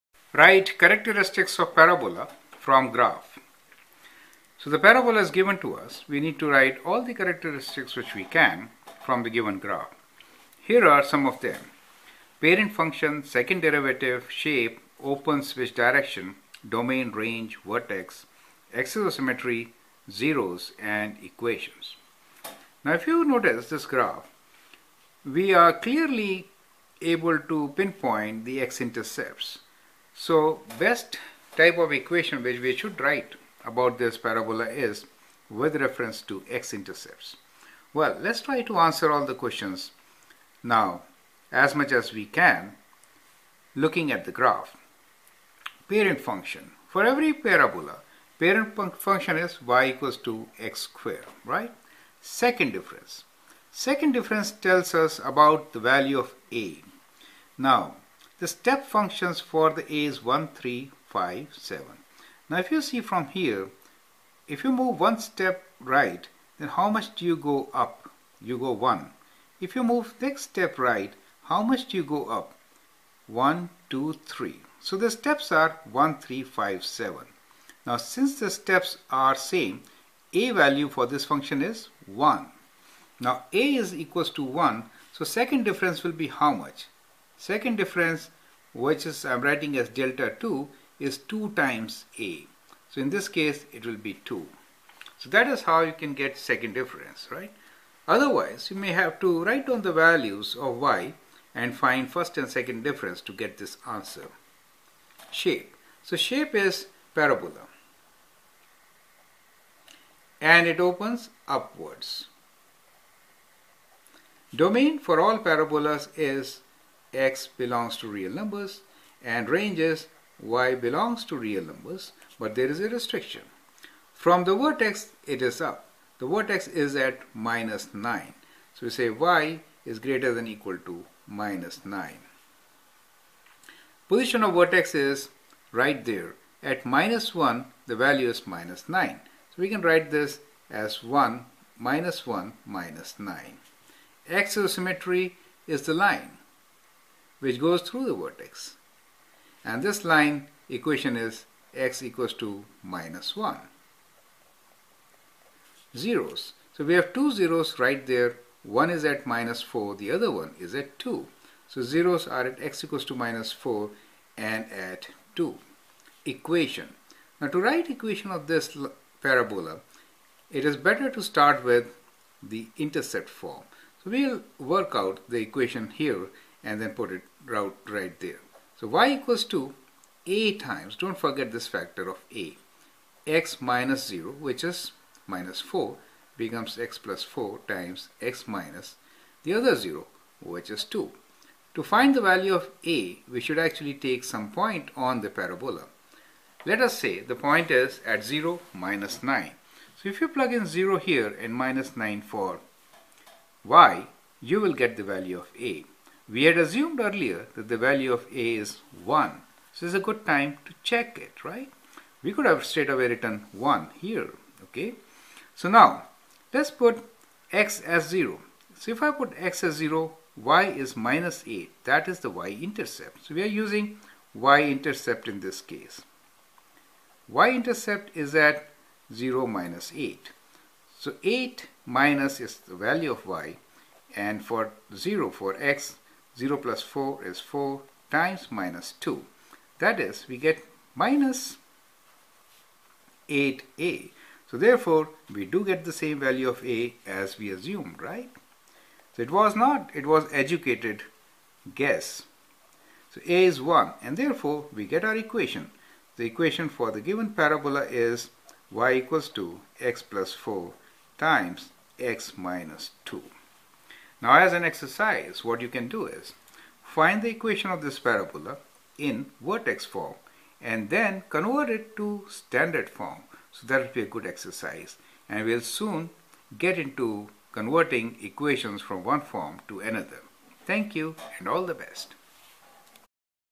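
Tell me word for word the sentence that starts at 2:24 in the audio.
Axis symmetry is the line which goes through the vertex.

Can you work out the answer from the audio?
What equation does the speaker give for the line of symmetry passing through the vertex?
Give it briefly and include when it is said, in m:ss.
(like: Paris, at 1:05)
x = -1, at 2:31.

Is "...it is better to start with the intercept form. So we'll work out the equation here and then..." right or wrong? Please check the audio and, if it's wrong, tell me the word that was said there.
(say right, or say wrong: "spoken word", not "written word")
right.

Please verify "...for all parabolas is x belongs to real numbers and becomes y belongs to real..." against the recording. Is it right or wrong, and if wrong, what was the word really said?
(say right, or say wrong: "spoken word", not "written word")
wrong: "ranges", not "becomes".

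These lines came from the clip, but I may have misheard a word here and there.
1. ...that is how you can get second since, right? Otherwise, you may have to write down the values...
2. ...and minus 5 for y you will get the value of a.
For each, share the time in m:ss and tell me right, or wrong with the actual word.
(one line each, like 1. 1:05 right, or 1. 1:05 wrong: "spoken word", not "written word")
1. 1:35 wrong: "difference", not "since"
2. 3:21 wrong: "9", not "5".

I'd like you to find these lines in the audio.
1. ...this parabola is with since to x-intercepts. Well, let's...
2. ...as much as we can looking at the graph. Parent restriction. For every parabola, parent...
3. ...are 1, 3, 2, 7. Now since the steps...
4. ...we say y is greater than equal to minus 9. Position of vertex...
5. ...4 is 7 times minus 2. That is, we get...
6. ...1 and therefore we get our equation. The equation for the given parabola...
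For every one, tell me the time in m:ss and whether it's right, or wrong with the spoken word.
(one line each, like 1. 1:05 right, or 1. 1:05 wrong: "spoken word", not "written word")
1. 0:33 wrong: "reference", not "since"
2. 0:41 wrong: "function", not "restriction"
3. 1:15 wrong: "5", not "2"
4. 2:08 right
5. 3:56 wrong: "4", not "7"
6. 4:13 right.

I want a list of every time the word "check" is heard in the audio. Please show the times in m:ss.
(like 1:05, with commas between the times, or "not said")
3:30.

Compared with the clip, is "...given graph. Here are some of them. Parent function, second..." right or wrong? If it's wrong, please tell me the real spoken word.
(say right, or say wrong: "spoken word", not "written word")
right.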